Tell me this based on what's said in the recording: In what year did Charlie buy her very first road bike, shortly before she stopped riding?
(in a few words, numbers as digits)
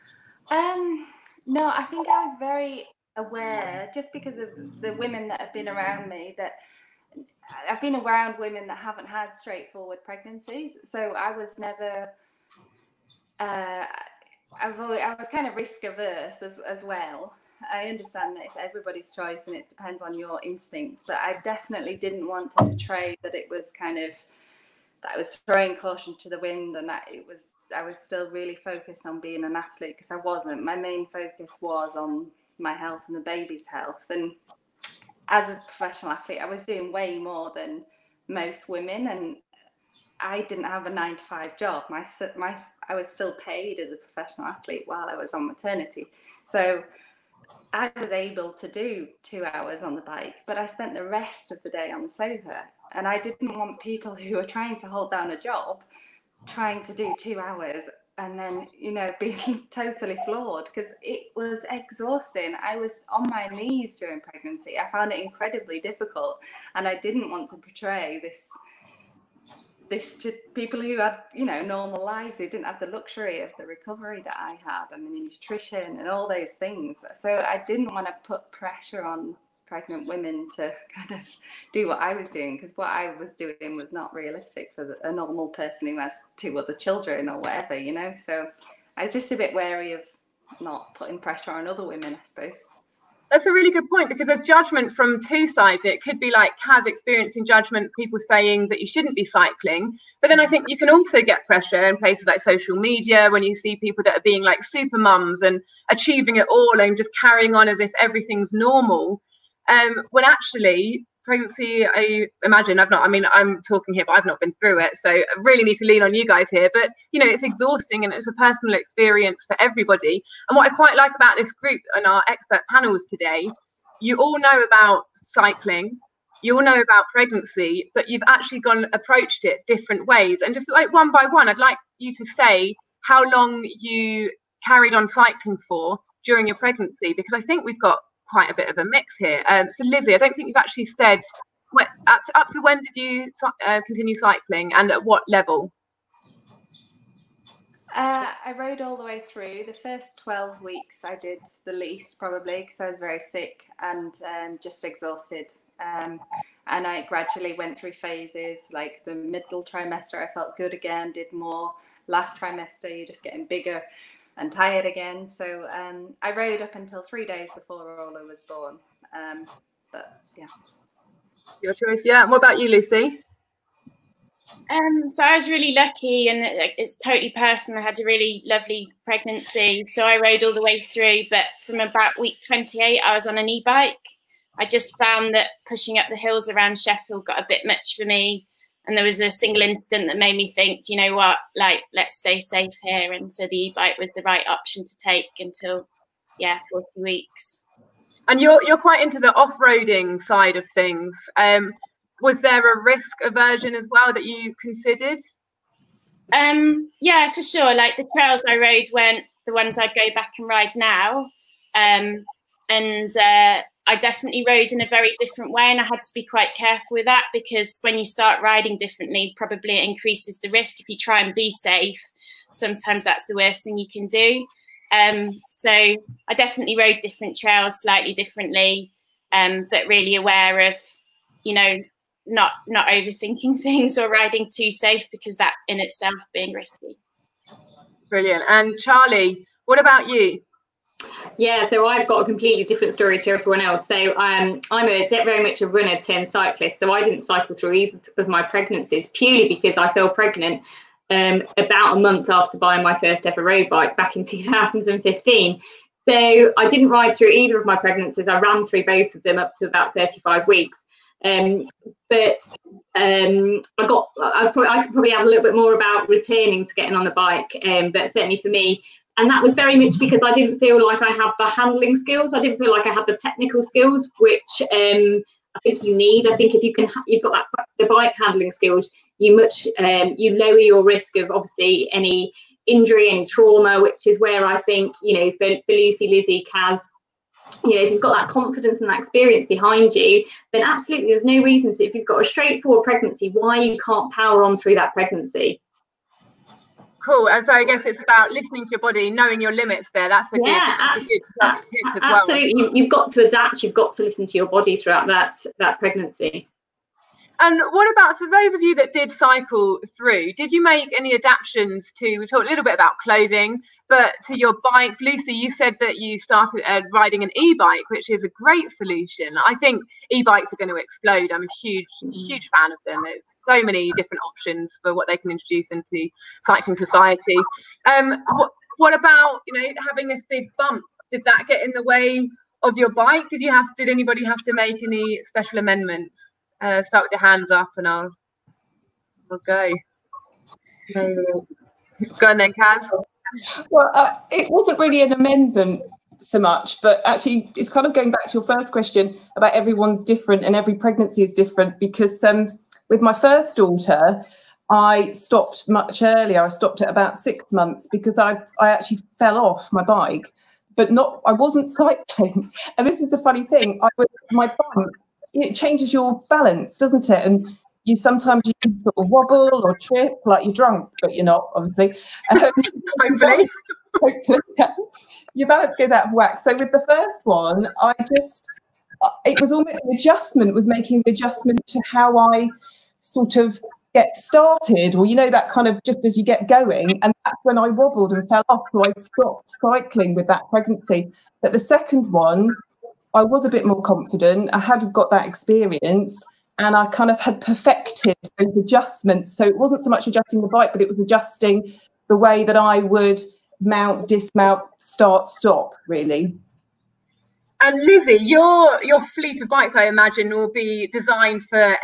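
2015.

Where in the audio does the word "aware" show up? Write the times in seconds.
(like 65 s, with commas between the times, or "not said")
3 s, 230 s.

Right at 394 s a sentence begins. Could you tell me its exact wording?
I had got that experience and I kind of had perfected those adjustments.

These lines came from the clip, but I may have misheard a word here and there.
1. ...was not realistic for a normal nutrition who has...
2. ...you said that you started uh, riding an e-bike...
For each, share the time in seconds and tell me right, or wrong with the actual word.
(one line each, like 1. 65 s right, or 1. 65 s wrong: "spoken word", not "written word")
1. 83 s wrong: "person", not "nutrition"
2. 315 s right.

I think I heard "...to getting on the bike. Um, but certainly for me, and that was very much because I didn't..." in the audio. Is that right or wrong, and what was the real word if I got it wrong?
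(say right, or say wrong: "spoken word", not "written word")
right.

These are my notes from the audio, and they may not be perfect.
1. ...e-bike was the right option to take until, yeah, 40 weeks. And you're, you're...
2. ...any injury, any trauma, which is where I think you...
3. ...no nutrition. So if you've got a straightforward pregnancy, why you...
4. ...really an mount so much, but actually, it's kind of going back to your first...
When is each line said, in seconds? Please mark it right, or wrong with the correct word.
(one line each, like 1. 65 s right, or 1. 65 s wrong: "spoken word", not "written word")
1. 193 s right
2. 281 s right
3. 291 s wrong: "reason", not "nutrition"
4. 344 s wrong: "amendment", not "mount".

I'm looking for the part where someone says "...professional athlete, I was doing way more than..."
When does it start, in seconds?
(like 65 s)
35 s.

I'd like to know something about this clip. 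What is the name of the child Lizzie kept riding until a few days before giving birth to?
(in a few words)
Orla.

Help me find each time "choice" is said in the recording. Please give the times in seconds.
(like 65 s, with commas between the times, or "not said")
19 s, 171 s.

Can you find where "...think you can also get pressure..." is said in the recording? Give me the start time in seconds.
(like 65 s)
100 s.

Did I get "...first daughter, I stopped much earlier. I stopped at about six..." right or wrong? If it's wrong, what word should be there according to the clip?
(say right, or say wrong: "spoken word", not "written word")
right.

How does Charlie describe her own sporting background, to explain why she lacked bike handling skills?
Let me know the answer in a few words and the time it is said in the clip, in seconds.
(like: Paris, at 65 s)
runner turned cyclist, at 245 s.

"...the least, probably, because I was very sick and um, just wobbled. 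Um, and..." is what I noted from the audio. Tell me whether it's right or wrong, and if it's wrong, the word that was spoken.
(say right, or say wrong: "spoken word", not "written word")
wrong: "exhausted", not "wobbled".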